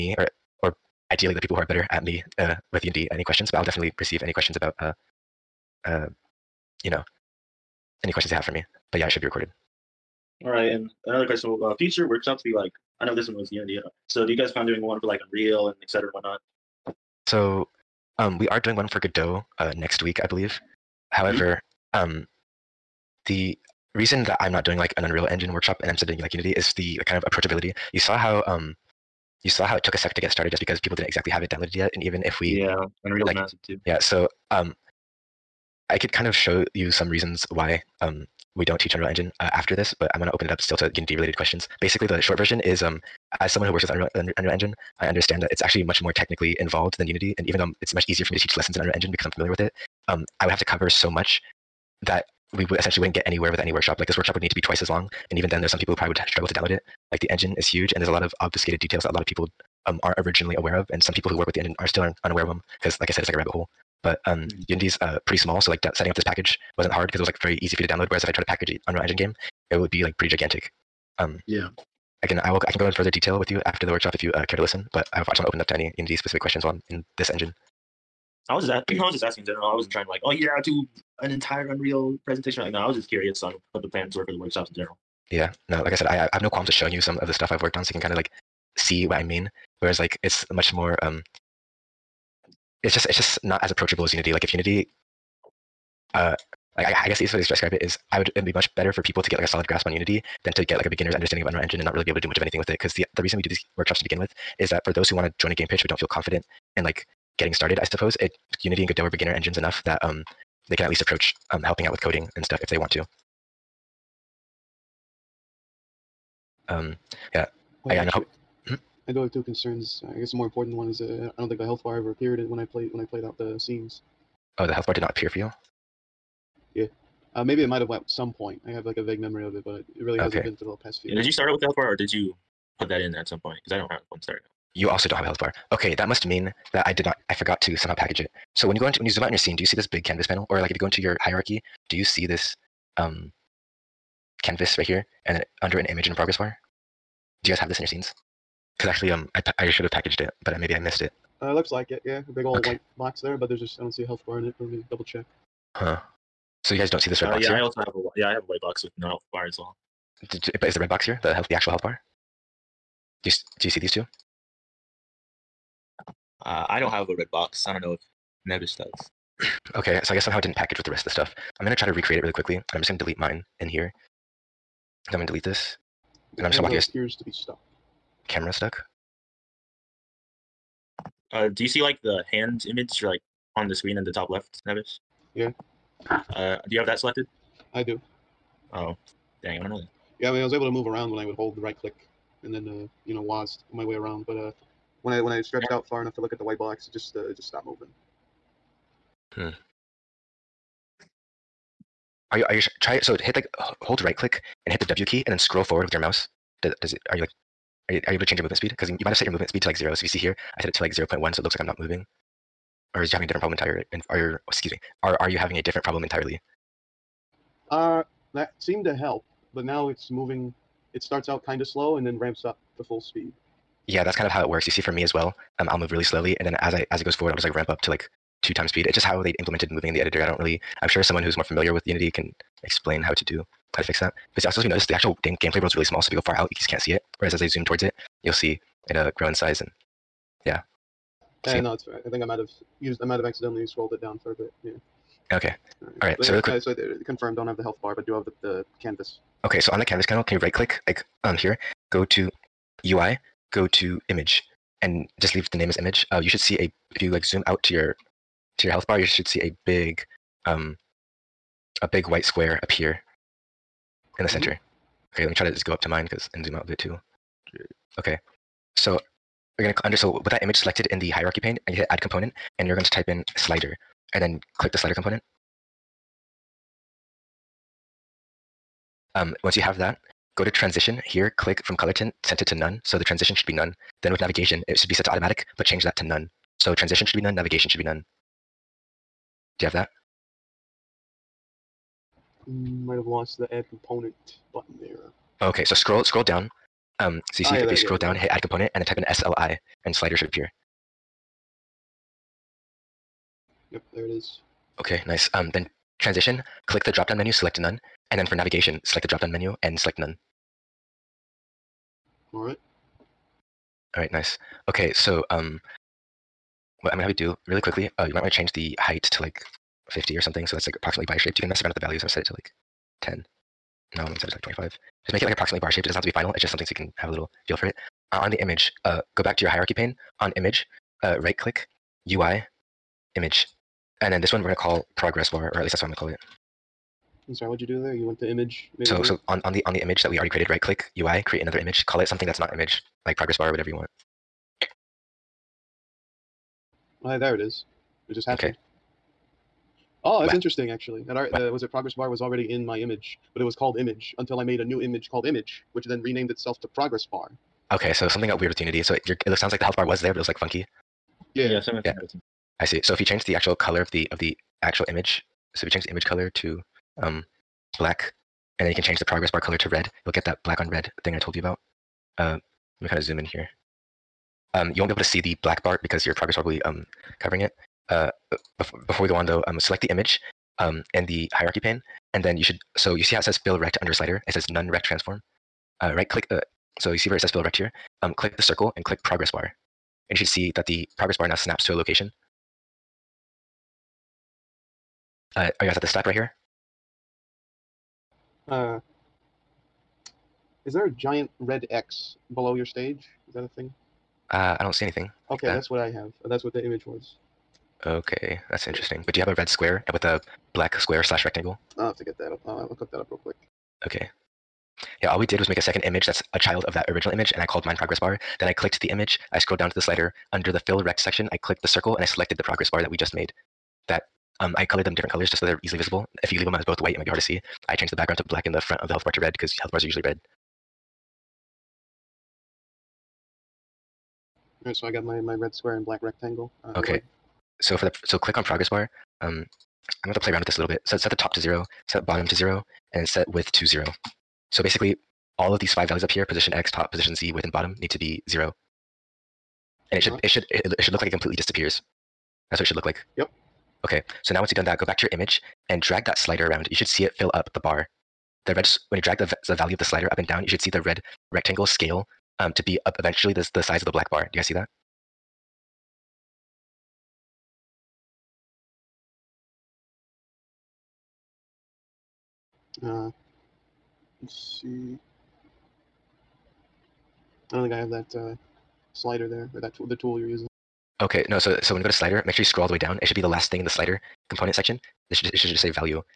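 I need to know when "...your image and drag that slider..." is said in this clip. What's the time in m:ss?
7:35.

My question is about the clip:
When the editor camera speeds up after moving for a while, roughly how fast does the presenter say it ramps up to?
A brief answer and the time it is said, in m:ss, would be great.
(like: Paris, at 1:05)
two times speed, at 3:48.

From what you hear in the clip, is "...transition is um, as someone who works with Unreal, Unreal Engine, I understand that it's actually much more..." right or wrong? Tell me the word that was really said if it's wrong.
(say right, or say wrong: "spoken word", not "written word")
wrong: "version", not "transition".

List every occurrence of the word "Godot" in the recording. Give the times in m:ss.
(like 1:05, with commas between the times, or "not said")
0:18, 1:48.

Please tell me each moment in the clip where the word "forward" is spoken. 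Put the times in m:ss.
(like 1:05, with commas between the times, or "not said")
3:25, 3:47.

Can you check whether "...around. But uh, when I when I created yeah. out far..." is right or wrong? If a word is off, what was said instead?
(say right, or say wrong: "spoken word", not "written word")
wrong: "stretched", not "created".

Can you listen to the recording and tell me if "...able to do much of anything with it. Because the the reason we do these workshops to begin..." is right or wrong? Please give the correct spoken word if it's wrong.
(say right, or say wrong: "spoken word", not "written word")
right.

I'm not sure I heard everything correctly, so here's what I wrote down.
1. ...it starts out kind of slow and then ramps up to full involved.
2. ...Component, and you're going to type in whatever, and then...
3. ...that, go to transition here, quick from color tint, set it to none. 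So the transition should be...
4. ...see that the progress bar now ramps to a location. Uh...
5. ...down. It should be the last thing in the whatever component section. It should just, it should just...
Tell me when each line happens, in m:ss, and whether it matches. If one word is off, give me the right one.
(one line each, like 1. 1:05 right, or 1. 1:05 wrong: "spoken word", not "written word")
1. 3:40 wrong: "speed", not "involved"
2. 4:31 wrong: "slider", not "whatever"
3. 4:39 wrong: "click", not "quick"
4. 6:30 wrong: "snaps", not "ramps"
5. 8:02 wrong: "slider", not "whatever".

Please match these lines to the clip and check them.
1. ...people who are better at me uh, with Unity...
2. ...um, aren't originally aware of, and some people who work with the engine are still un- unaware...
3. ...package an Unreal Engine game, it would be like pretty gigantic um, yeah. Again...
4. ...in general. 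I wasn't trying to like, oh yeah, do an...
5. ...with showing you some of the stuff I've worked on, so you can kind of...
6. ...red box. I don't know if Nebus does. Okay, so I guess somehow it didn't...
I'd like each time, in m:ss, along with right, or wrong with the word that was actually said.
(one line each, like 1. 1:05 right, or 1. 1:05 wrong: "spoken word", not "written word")
1. 0:01 right
2. 0:59 right
3. 1:08 right
4. 1:19 right
5. 1:26 right
6. 2:47 right.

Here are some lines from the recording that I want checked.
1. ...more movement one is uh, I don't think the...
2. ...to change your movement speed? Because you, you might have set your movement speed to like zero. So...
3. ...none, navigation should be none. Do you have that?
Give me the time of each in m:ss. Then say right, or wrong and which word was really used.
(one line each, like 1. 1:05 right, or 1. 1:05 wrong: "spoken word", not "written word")
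1. 2:00 wrong: "important", not "movement"
2. 3:28 right
3. 4:47 right.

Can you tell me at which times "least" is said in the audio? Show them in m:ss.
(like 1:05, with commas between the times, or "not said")
1:50, 5:35.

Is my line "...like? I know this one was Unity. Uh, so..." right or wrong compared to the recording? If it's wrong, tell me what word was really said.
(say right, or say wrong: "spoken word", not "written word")
right.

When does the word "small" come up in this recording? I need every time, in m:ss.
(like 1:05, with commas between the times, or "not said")
1:05, 3:55.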